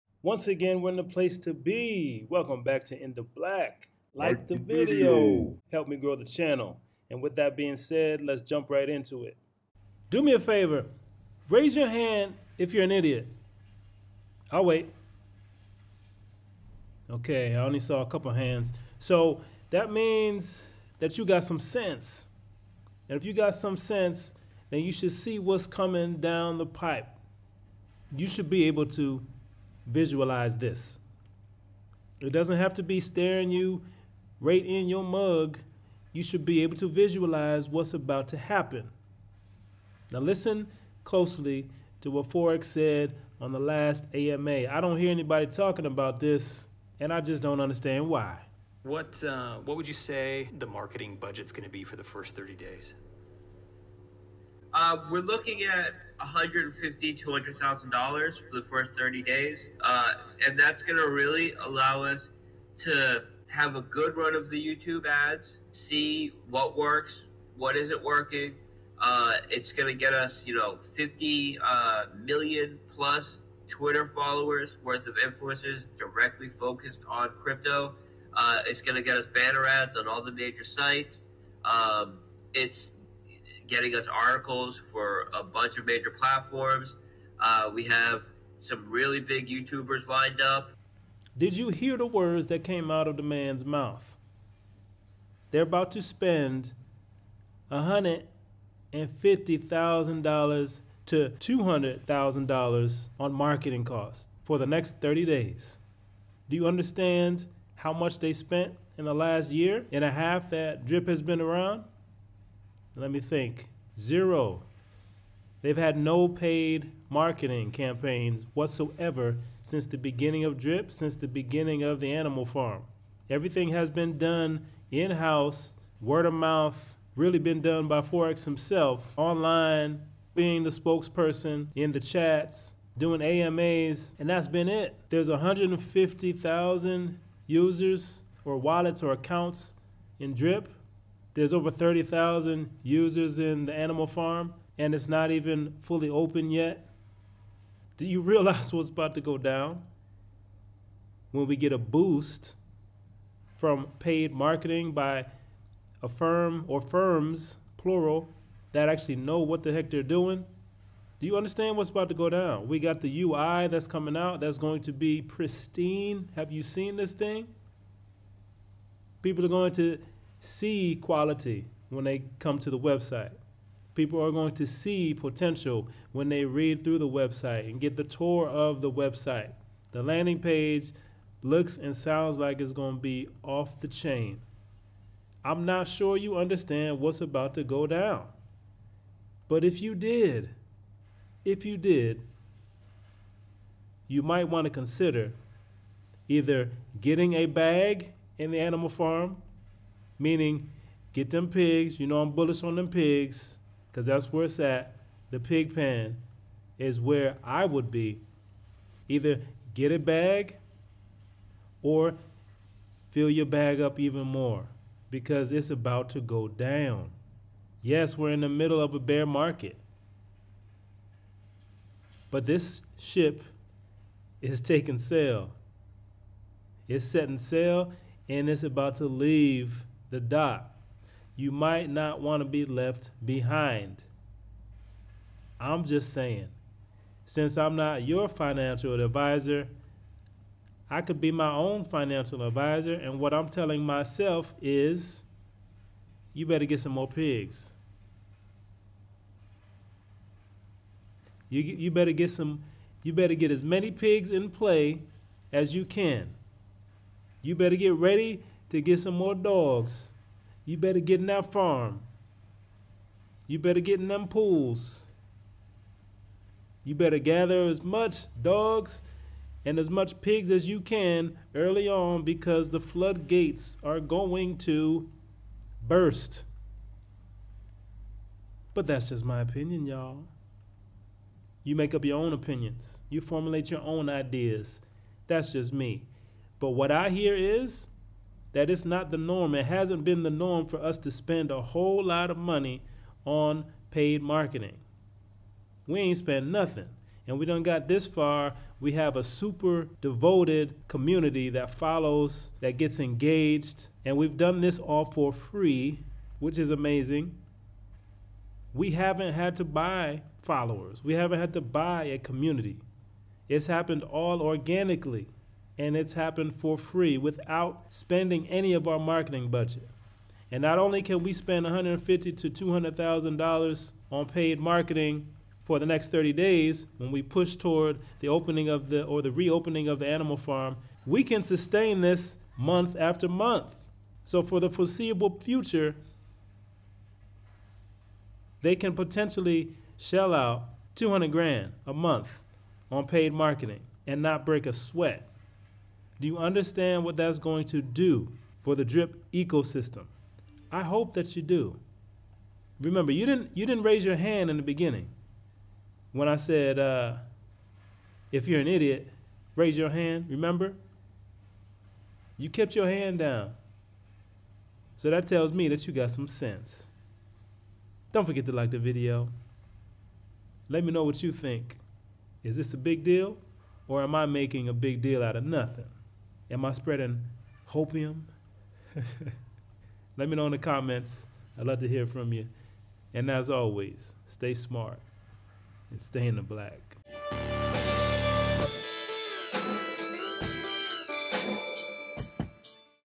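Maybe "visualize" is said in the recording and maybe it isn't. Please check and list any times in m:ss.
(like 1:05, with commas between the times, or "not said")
0:29, 0:36.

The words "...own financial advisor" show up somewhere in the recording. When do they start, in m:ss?
4:01.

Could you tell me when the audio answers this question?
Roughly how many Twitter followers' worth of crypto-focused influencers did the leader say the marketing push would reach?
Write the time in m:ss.
1:10.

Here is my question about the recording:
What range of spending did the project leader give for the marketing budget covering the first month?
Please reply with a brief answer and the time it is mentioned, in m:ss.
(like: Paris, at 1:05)
$150,000 to $200,000, at 0:56.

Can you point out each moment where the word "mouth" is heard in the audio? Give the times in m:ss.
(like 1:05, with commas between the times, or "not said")
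1:33, 2:06.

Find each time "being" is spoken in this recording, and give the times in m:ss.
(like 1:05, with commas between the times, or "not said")
0:07, 2:10.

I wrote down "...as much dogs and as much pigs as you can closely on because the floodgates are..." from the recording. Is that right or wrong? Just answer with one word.
wrong.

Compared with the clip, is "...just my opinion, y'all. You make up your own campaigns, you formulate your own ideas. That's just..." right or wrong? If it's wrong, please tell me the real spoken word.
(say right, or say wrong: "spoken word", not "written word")
wrong: "opinions", not "campaigns".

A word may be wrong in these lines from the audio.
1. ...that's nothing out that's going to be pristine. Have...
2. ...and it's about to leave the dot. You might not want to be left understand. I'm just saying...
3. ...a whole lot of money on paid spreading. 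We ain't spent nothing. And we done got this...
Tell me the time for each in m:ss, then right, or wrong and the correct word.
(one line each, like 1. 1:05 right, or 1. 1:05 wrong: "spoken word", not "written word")
1. 2:43 wrong: "coming", not "nothing"
2. 3:48 wrong: "behind", not "understand"
3. 4:51 wrong: "marketing", not "spreading".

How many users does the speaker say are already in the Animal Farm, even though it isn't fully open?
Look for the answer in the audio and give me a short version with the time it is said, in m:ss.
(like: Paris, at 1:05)
over 30,000, at 2:21.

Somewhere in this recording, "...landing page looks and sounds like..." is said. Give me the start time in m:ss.
3:00.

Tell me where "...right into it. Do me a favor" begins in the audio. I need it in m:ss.
0:08.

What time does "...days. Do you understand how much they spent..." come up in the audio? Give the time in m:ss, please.
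1:45.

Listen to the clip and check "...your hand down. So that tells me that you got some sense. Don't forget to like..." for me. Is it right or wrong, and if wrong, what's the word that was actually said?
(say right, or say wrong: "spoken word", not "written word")
right.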